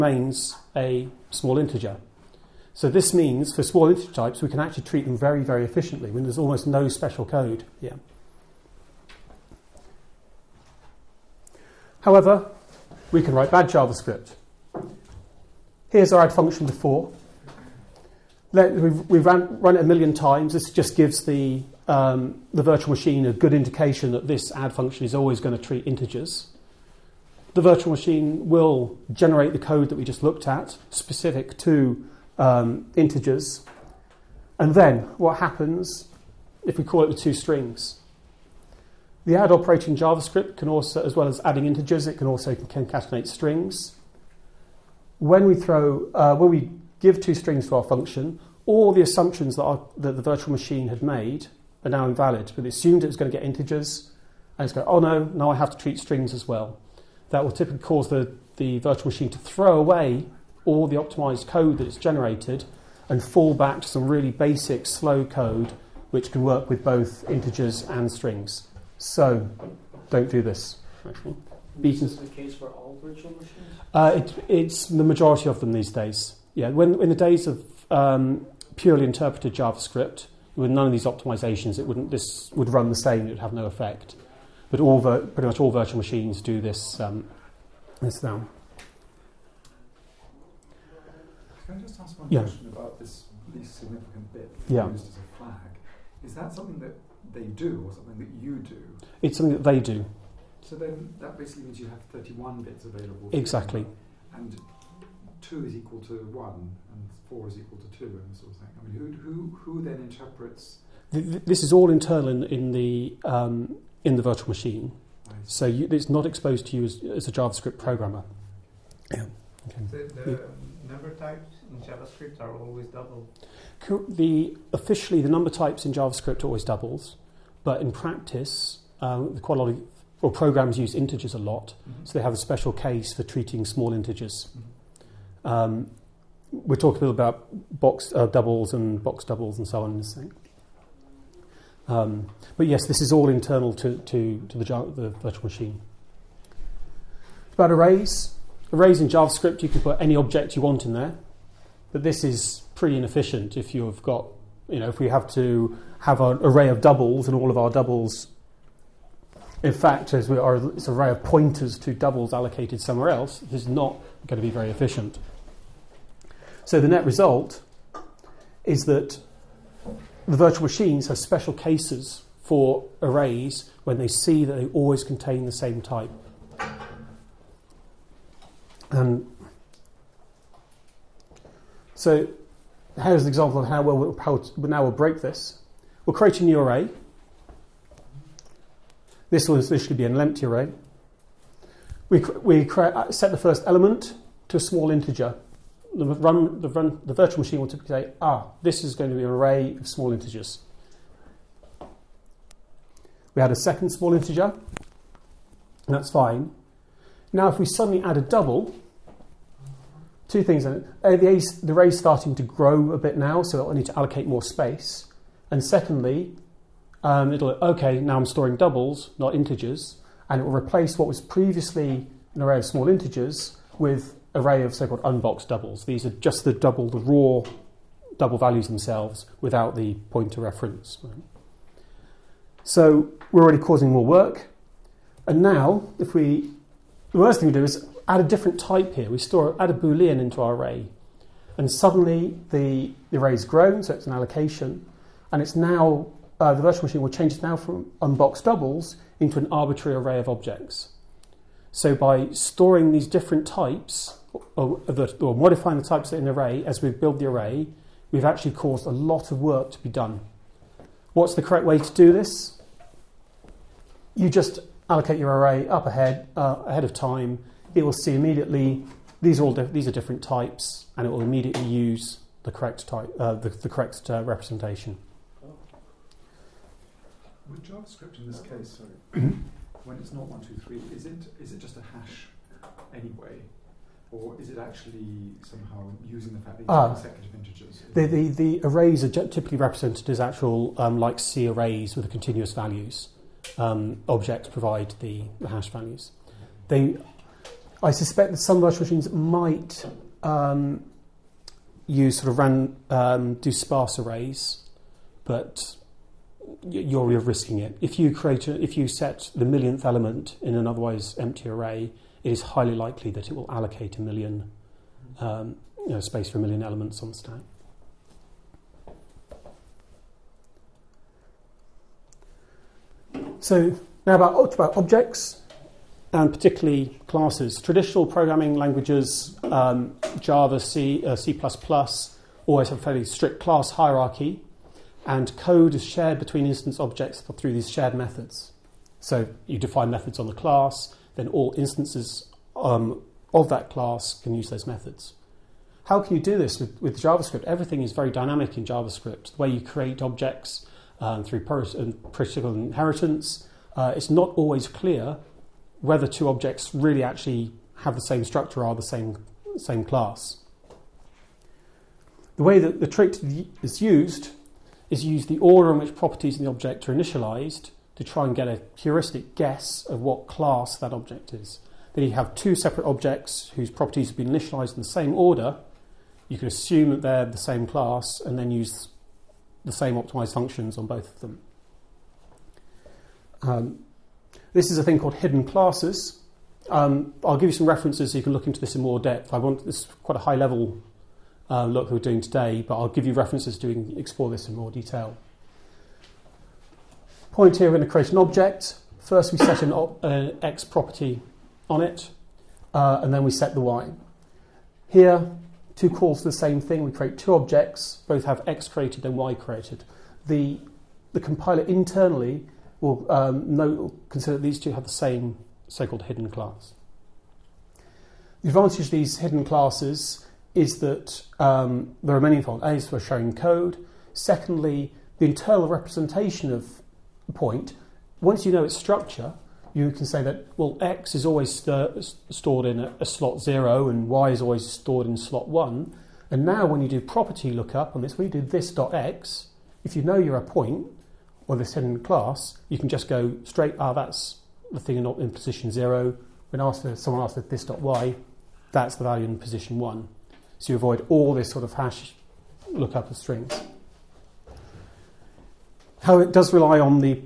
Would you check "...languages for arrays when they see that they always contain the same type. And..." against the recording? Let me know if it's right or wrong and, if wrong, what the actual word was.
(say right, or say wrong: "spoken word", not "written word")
wrong: "cases", not "languages".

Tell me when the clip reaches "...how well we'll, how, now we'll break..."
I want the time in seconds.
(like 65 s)
183 s.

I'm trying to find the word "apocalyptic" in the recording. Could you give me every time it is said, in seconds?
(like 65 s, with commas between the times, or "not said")
not said.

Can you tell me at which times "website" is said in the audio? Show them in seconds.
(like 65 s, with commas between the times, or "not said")
not said.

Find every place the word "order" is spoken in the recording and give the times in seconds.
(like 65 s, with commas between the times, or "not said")
365 s, 375 s.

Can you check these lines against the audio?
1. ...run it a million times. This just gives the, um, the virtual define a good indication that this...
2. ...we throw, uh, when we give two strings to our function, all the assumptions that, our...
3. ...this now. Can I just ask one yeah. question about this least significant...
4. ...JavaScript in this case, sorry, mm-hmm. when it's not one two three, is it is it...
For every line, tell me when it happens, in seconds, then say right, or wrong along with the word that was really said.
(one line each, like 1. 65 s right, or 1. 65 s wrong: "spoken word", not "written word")
1. 19 s wrong: "machine", not "define"
2. 45 s right
3. 88 s right
4. 277 s right.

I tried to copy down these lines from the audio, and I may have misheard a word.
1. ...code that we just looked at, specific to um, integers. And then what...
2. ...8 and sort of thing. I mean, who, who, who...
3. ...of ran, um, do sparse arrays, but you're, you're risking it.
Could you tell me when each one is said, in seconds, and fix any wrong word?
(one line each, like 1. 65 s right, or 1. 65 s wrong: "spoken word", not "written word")
1. 29 s right
2. 107 s wrong: "2", not "8"
3. 302 s right.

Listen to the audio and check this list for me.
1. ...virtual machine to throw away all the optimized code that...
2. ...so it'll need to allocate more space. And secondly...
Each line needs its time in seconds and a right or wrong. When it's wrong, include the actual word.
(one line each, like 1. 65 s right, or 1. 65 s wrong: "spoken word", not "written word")
1. 58 s right
2. 213 s right.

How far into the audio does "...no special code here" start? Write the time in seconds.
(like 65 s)
6 s.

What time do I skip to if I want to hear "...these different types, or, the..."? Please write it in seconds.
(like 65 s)
252 s.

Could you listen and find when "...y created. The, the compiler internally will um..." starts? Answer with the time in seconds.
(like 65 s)
409 s.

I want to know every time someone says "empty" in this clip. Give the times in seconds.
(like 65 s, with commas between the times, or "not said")
190 s, 311 s.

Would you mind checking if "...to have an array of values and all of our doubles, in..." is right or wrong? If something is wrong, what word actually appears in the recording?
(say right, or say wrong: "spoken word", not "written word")
wrong: "doubles", not "values".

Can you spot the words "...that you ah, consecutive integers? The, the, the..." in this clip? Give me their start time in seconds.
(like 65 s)
286 s.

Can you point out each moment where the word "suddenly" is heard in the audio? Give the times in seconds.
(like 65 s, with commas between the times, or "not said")
207 s, 241 s.